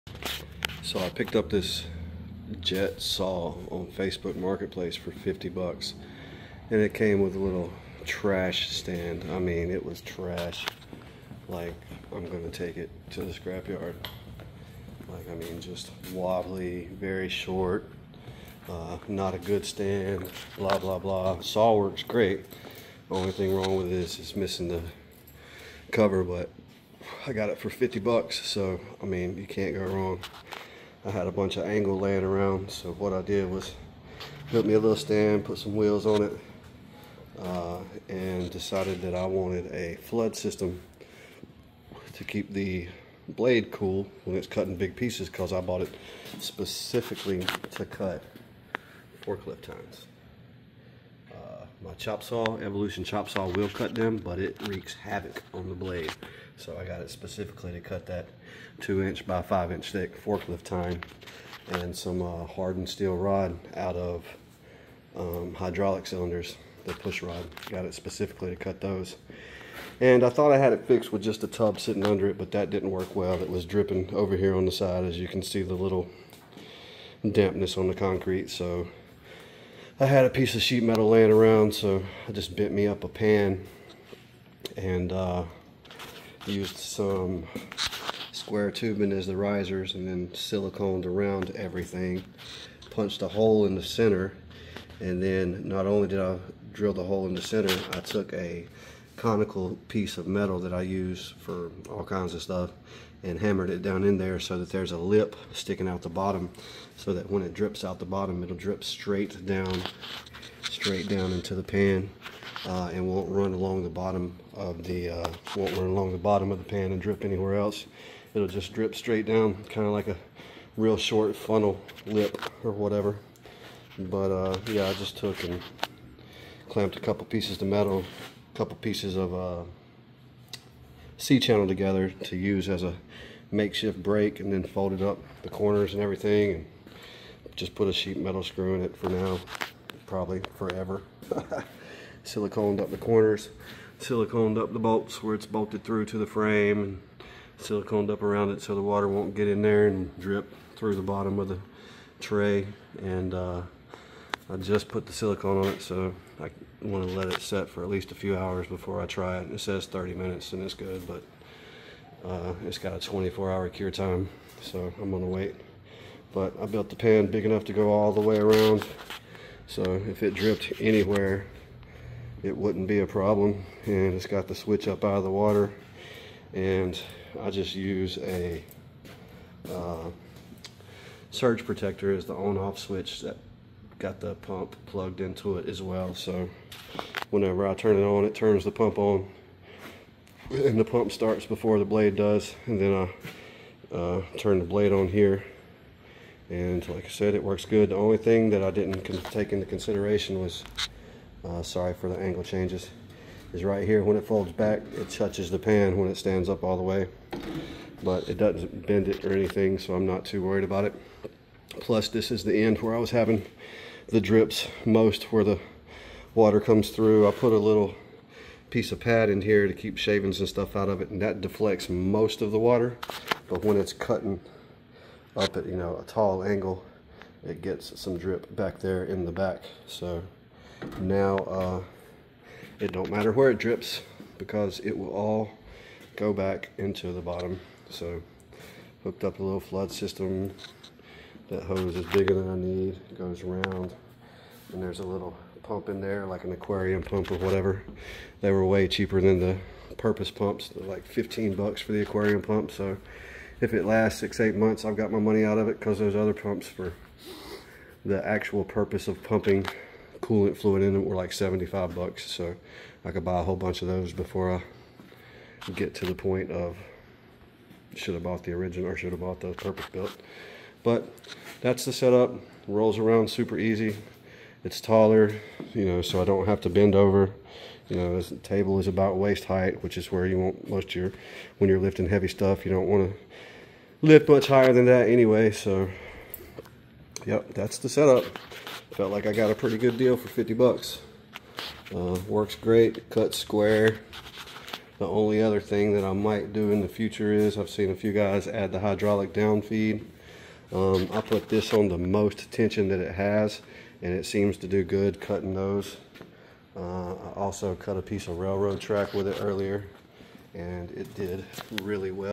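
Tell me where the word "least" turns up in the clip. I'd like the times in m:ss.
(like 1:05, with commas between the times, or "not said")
2:37.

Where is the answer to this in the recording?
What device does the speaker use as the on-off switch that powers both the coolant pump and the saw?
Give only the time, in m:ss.
3:01.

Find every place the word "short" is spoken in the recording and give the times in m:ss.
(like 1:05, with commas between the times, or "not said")
0:17, 2:00.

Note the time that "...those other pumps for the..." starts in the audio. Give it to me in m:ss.
4:15.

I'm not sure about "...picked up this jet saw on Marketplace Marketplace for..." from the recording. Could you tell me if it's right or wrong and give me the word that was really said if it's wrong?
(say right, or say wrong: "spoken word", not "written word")
wrong: "Facebook", not "Marketplace".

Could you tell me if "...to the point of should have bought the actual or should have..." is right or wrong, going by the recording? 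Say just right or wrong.
wrong.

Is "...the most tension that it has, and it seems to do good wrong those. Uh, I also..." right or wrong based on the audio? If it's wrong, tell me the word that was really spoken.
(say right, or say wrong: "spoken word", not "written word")
wrong: "cutting", not "wrong".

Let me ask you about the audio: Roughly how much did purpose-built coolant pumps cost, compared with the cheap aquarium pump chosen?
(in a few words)
$75.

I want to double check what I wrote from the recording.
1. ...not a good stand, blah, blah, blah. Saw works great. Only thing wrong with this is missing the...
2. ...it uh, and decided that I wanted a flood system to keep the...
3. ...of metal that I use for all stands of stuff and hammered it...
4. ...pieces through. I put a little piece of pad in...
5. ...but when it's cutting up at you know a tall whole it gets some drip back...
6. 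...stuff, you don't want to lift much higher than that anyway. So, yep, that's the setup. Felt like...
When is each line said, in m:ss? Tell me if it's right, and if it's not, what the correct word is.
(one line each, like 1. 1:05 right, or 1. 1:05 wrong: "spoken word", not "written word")
1. 0:19 right
2. 0:36 right
3. 1:40 wrong: "kinds", not "stands"
4. 3:36 wrong: "comes", not "pieces"
5. 3:43 wrong: "angle", not "whole"
6. 4:42 right.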